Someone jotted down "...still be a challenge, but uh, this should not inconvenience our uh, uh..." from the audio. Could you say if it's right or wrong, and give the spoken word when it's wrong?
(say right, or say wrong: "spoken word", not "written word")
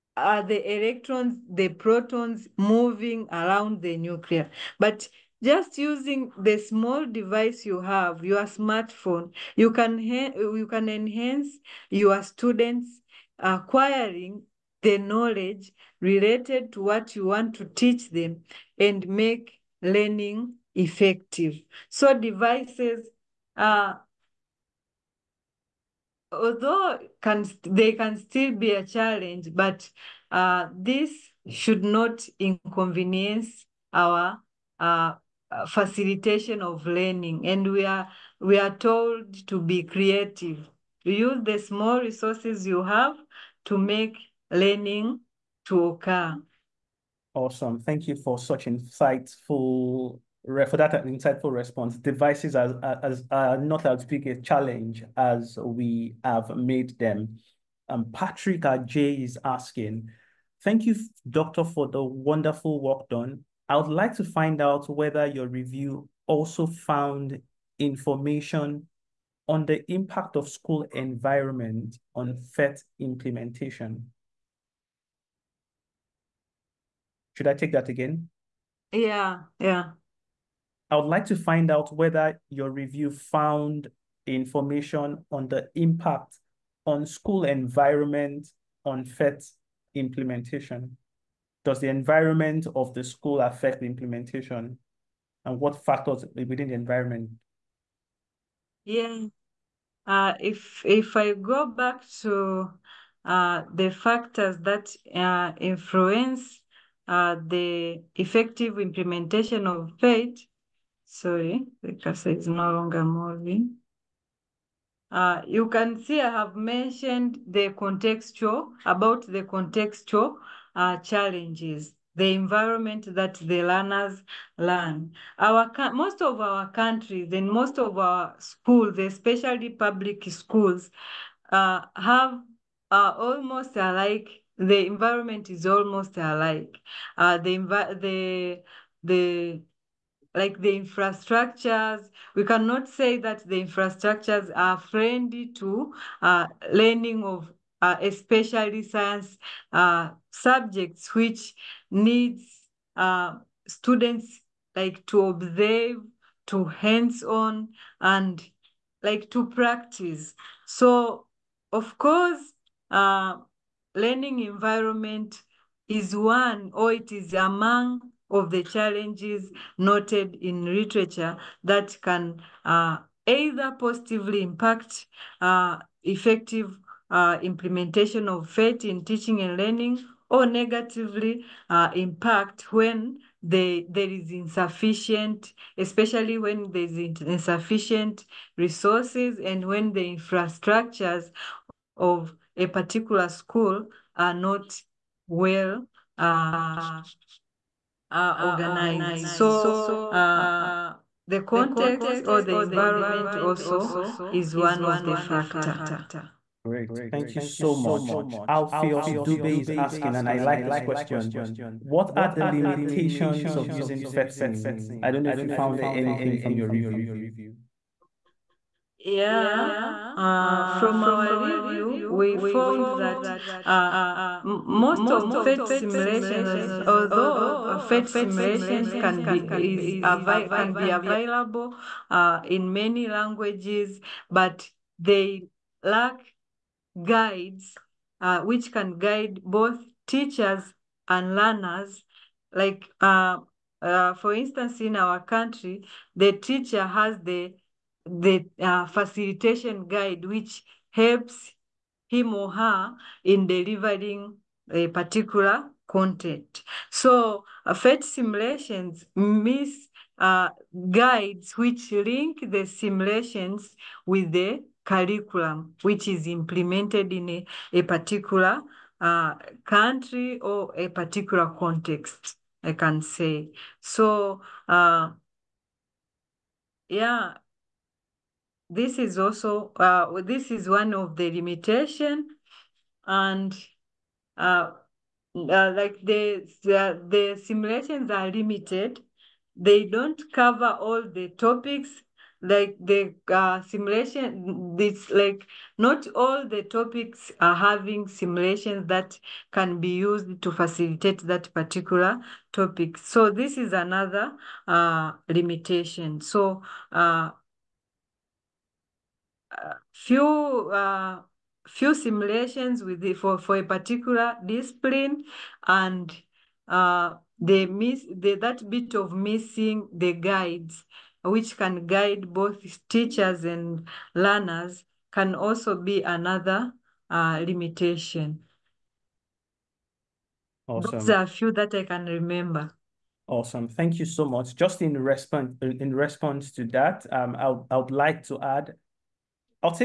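right.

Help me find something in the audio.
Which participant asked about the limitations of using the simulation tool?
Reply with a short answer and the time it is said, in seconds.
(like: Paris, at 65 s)
Alpheus Dube, at 208 s.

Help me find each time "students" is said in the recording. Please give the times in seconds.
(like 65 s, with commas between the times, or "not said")
12 s, 153 s.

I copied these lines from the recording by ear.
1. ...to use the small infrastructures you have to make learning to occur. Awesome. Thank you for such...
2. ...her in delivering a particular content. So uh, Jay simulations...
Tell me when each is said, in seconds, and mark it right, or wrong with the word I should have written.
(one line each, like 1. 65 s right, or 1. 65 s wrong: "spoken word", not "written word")
1. 41 s wrong: "resources", not "infrastructures"
2. 252 s wrong: "PhET", not "Jay".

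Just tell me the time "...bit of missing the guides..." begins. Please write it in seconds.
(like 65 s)
318 s.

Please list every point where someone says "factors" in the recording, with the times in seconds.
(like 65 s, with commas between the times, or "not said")
95 s, 103 s, 205 s.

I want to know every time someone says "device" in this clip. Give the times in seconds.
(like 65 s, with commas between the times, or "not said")
7 s, 22 s, 51 s.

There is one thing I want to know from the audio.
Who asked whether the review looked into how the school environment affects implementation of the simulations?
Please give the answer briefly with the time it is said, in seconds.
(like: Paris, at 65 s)
Patrick Jay, at 58 s.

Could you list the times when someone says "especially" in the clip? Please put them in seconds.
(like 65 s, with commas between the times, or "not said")
128 s, 148 s, 185 s.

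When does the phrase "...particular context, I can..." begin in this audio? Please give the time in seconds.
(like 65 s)
270 s.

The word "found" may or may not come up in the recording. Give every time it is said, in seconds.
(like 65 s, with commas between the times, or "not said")
66 s, 83 s, 215 s, 222 s.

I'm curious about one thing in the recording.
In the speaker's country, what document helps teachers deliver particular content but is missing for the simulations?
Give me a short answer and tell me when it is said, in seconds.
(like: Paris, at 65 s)
facilitation guide, at 248 s.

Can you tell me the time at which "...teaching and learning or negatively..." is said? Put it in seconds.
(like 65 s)
179 s.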